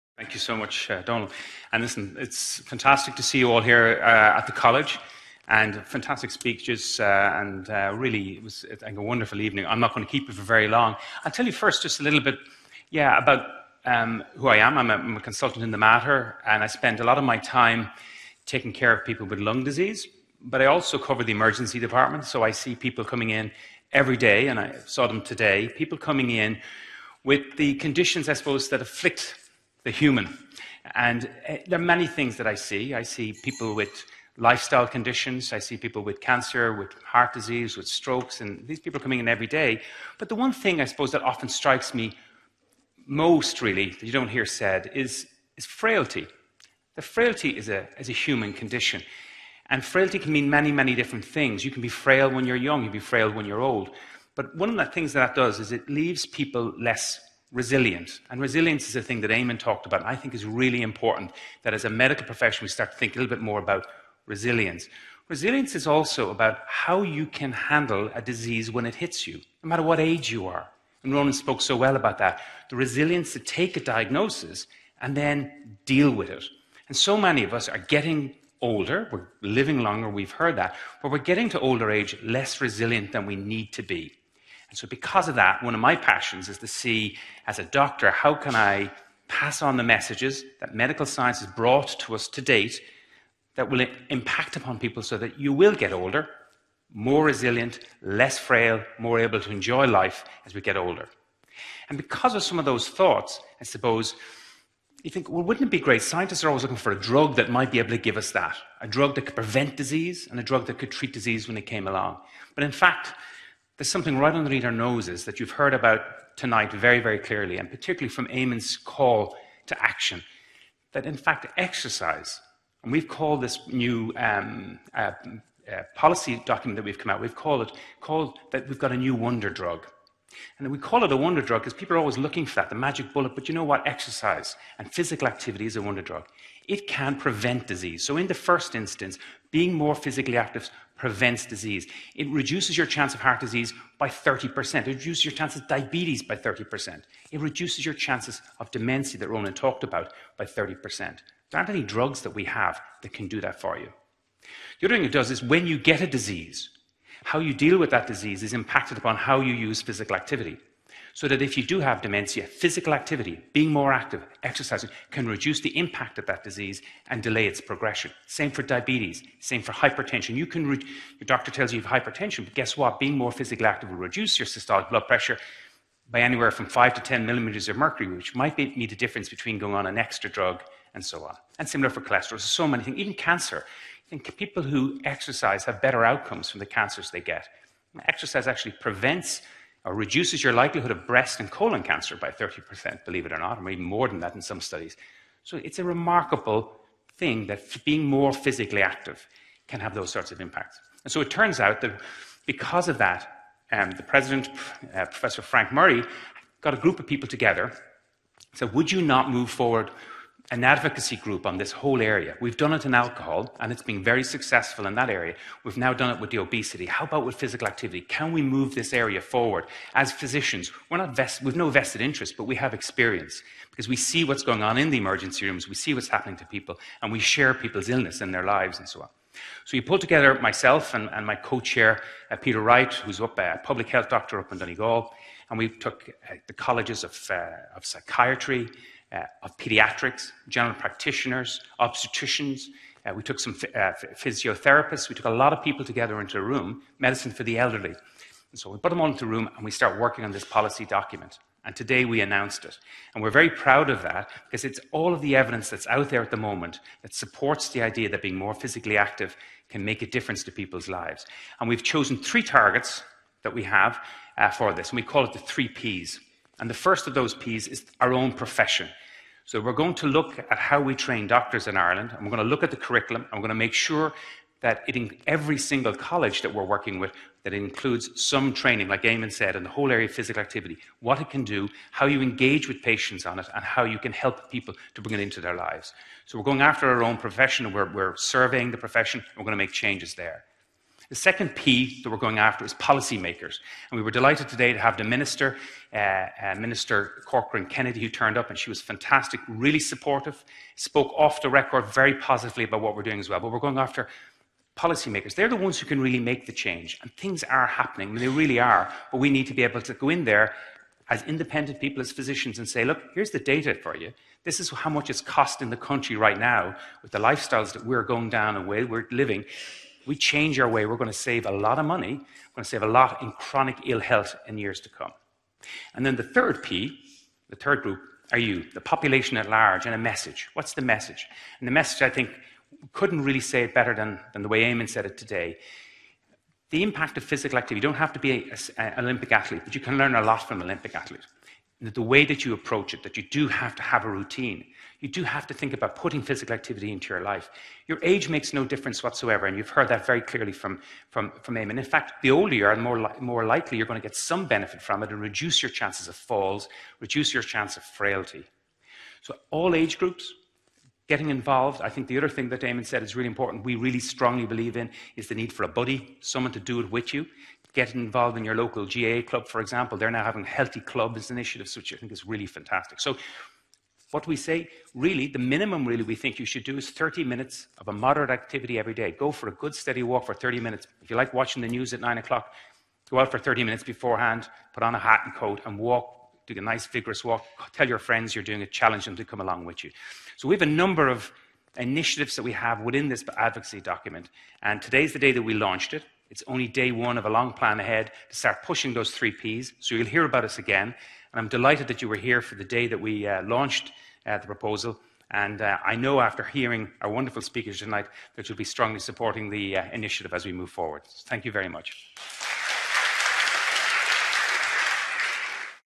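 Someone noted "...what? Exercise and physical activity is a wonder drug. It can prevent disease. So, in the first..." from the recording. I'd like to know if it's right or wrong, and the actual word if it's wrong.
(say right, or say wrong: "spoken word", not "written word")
right.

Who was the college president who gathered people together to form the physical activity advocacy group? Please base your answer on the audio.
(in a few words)
Professor Frank Murray.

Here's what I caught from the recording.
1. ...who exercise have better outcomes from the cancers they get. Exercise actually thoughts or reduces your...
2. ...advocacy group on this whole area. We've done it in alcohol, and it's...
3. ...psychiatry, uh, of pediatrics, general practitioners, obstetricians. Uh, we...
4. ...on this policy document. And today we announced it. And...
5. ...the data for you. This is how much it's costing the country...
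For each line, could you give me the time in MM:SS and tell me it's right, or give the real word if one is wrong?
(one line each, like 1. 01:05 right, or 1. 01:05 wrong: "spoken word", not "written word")
1. 03:04 wrong: "prevents", not "thoughts"
2. 03:30 right
3. 03:57 right
4. 04:10 right
5. 05:13 right.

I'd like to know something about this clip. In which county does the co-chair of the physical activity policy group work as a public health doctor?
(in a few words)
Donegal.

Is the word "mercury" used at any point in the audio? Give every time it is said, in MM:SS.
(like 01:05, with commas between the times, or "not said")
02:57.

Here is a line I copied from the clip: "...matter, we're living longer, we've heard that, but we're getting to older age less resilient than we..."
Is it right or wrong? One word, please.
wrong.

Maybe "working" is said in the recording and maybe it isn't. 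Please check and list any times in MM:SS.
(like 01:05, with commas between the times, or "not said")
04:09, 04:36.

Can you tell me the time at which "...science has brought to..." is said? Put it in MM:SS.
01:31.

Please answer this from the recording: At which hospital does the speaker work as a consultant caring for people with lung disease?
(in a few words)
The Mater.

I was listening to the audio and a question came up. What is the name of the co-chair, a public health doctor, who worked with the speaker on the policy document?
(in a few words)
Peter Wright.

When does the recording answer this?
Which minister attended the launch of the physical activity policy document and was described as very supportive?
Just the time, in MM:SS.
04:56.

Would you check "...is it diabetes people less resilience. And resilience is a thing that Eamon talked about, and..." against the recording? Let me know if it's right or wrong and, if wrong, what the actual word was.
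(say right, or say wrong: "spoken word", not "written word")
wrong: "leaves", not "diabetes".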